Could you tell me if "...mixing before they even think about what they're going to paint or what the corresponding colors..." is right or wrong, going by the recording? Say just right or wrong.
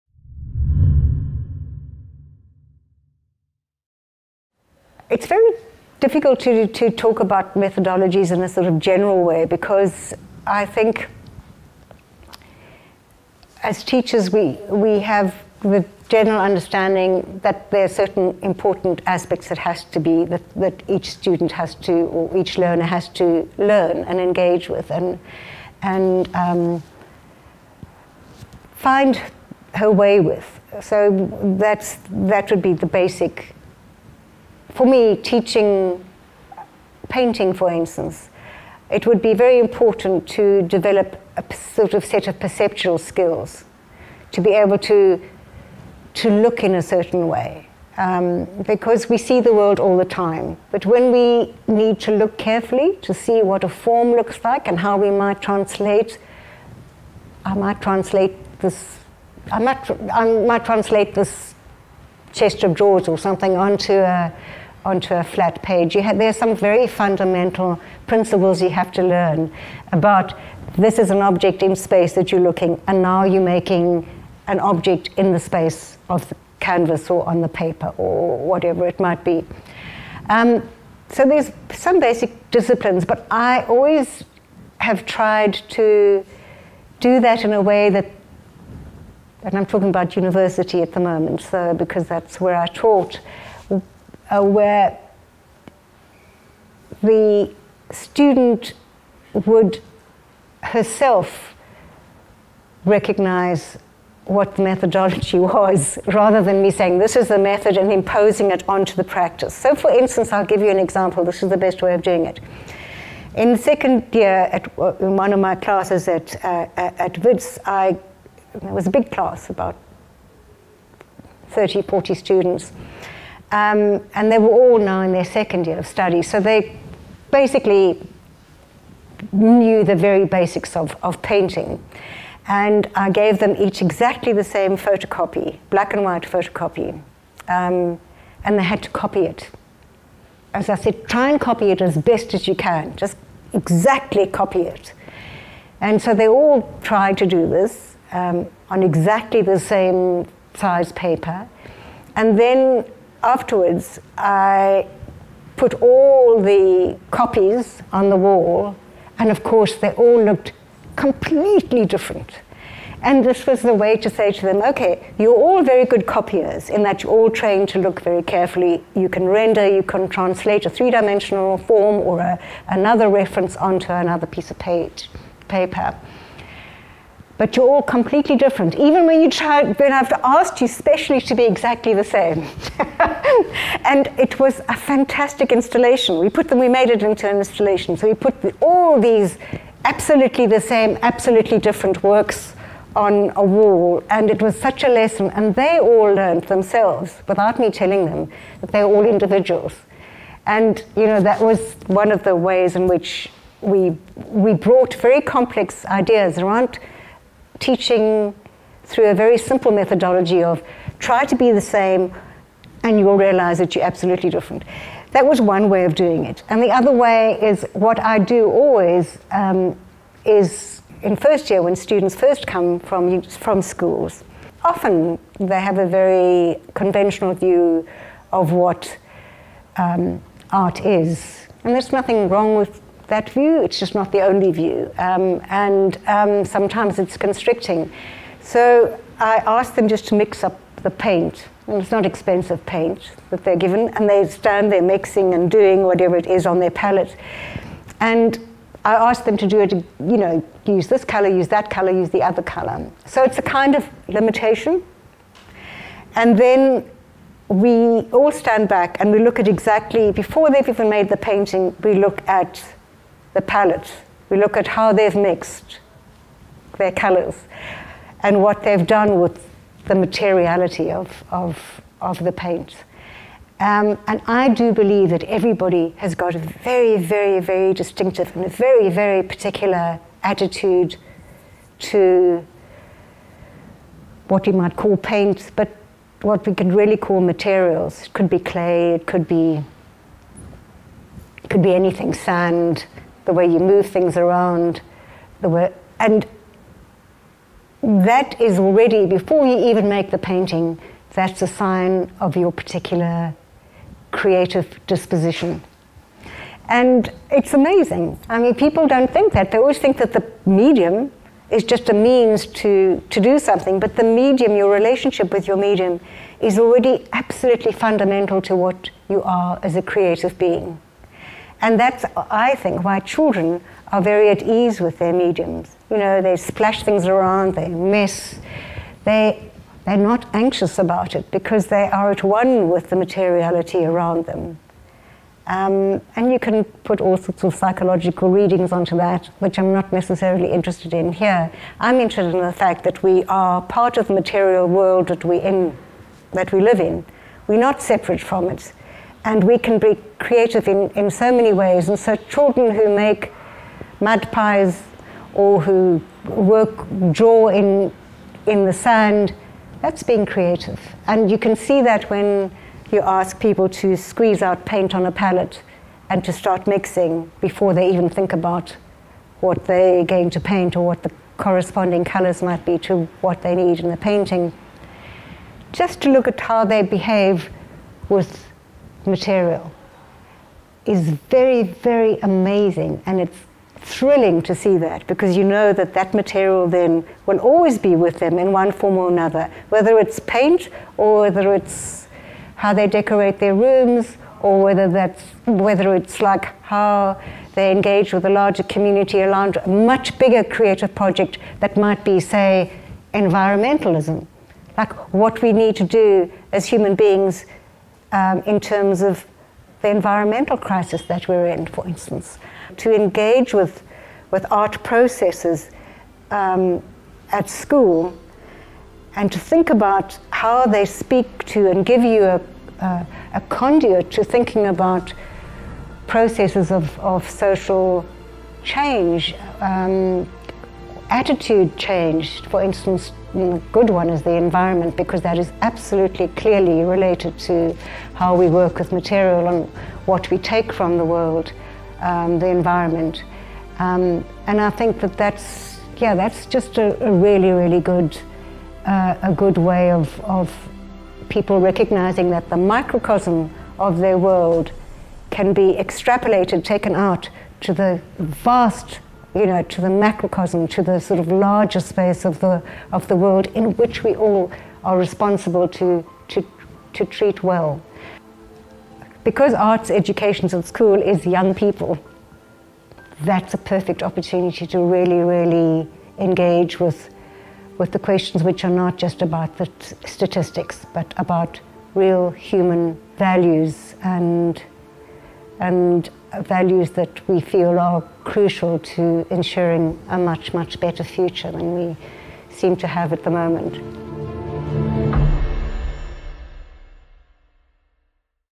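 right.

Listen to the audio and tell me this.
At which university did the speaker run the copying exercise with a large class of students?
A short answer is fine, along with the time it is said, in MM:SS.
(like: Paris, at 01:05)
Wits, at 01:57.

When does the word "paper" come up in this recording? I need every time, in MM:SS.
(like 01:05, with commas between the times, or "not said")
01:17, 02:30, 02:55.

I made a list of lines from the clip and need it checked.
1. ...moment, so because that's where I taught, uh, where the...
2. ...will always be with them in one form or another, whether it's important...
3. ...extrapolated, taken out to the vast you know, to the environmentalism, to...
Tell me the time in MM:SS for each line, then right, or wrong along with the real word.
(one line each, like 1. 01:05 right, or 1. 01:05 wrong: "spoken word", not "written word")
1. 01:31 right
2. 06:27 wrong: "paint", not "important"
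3. 07:35 wrong: "macrocosm", not "environmentalism".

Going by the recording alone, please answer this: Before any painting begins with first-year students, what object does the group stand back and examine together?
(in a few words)
the palette.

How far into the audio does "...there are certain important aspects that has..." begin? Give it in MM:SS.
00:17.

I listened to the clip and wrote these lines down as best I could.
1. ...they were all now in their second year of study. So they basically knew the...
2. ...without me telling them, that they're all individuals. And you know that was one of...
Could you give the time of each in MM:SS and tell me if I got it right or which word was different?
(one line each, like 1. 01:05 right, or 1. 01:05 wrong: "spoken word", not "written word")
1. 02:04 right
2. 03:17 right.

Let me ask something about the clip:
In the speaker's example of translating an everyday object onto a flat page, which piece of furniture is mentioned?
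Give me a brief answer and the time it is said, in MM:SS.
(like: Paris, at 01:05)
chest of drawers, at 01:02.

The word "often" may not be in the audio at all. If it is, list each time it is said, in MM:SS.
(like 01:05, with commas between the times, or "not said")
03:44.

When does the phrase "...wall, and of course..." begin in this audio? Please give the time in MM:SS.
02:38.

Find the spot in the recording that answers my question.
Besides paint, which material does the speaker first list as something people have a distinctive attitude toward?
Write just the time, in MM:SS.
04:48.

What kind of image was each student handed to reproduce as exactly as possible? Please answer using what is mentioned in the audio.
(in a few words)
black and white photocopy.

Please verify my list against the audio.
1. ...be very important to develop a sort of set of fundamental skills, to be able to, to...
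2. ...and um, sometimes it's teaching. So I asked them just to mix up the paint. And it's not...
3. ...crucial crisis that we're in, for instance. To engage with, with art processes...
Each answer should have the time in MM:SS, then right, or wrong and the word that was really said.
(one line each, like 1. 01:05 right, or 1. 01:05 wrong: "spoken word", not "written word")
1. 00:39 wrong: "perceptual", not "fundamental"
2. 03:55 wrong: "constricting", not "teaching"
3. 06:49 wrong: "environmental", not "crucial".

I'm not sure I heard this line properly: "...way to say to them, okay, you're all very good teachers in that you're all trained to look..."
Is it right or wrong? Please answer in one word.
wrong.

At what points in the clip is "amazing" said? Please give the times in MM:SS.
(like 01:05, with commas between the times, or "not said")
05:07, 06:22.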